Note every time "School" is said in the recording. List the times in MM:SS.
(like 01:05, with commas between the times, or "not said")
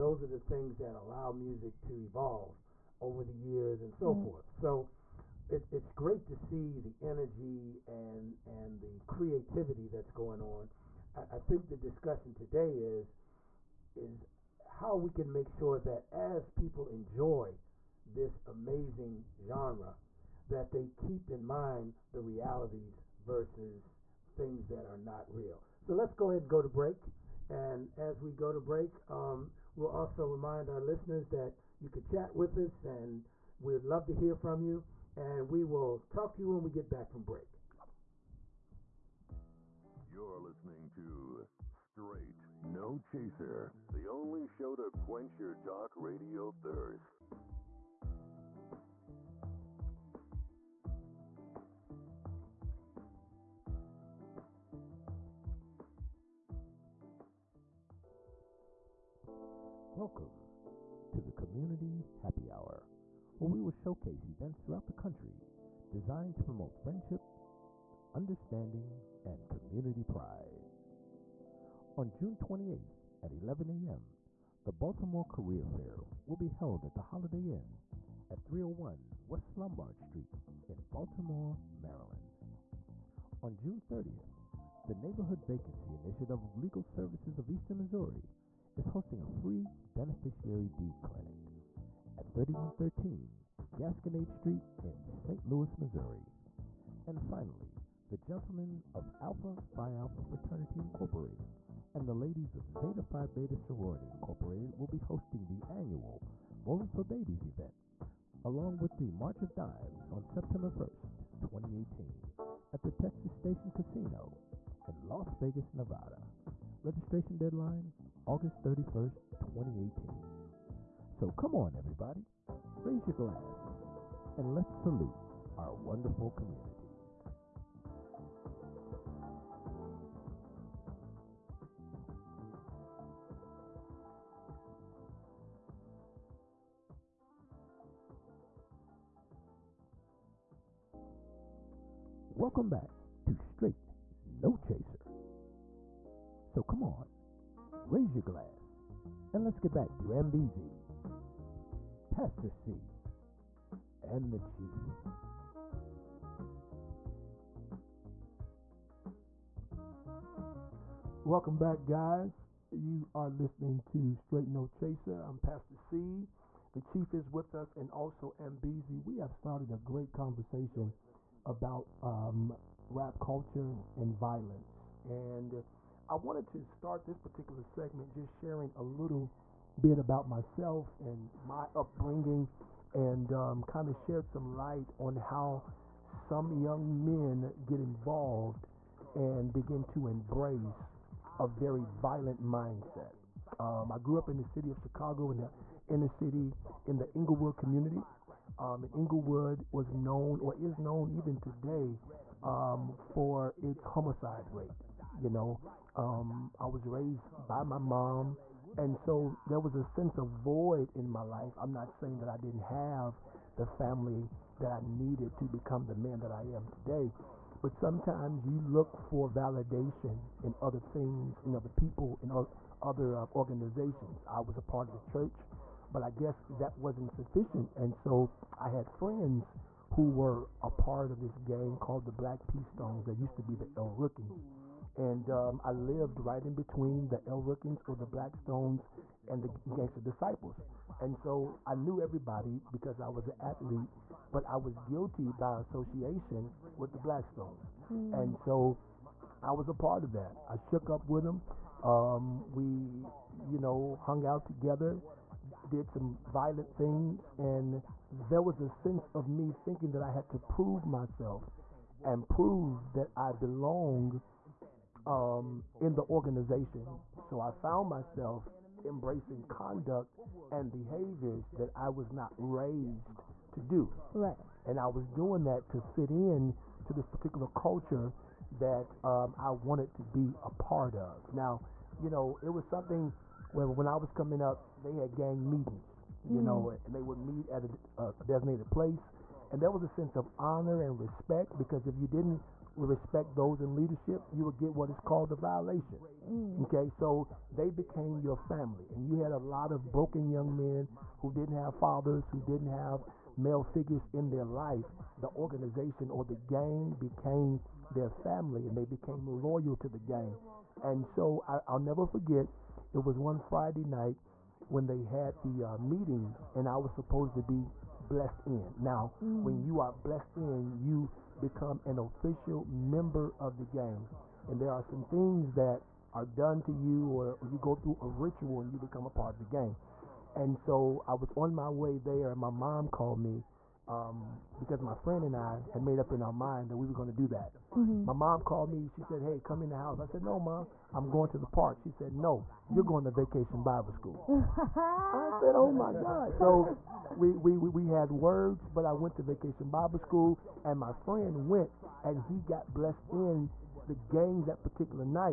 05:43, 05:49.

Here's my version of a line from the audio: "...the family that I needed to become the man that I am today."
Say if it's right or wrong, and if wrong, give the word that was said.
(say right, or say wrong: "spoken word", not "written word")
right.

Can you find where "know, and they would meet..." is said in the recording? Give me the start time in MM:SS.
04:46.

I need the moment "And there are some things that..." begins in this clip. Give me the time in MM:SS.
05:24.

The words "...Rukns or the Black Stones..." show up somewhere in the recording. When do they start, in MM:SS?
03:57.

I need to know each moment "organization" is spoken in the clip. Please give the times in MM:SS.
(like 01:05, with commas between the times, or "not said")
03:43, 04:26, 05:05.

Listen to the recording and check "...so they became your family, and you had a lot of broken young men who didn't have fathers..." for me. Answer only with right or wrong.
right.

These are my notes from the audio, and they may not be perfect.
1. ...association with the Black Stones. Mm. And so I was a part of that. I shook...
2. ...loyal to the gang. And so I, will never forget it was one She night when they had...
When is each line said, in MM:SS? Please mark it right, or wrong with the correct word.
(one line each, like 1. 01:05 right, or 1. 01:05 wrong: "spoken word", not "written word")
1. 04:05 right
2. 05:09 wrong: "Friday", not "She".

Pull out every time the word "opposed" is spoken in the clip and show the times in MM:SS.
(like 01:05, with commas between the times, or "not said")
not said.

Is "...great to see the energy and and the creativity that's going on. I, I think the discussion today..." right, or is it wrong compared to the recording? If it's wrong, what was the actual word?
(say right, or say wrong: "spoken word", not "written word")
right.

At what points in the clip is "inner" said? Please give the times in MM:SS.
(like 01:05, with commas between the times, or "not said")
03:15.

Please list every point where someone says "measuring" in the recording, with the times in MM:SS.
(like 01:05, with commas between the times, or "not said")
not said.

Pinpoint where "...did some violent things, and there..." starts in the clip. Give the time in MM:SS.
04:15.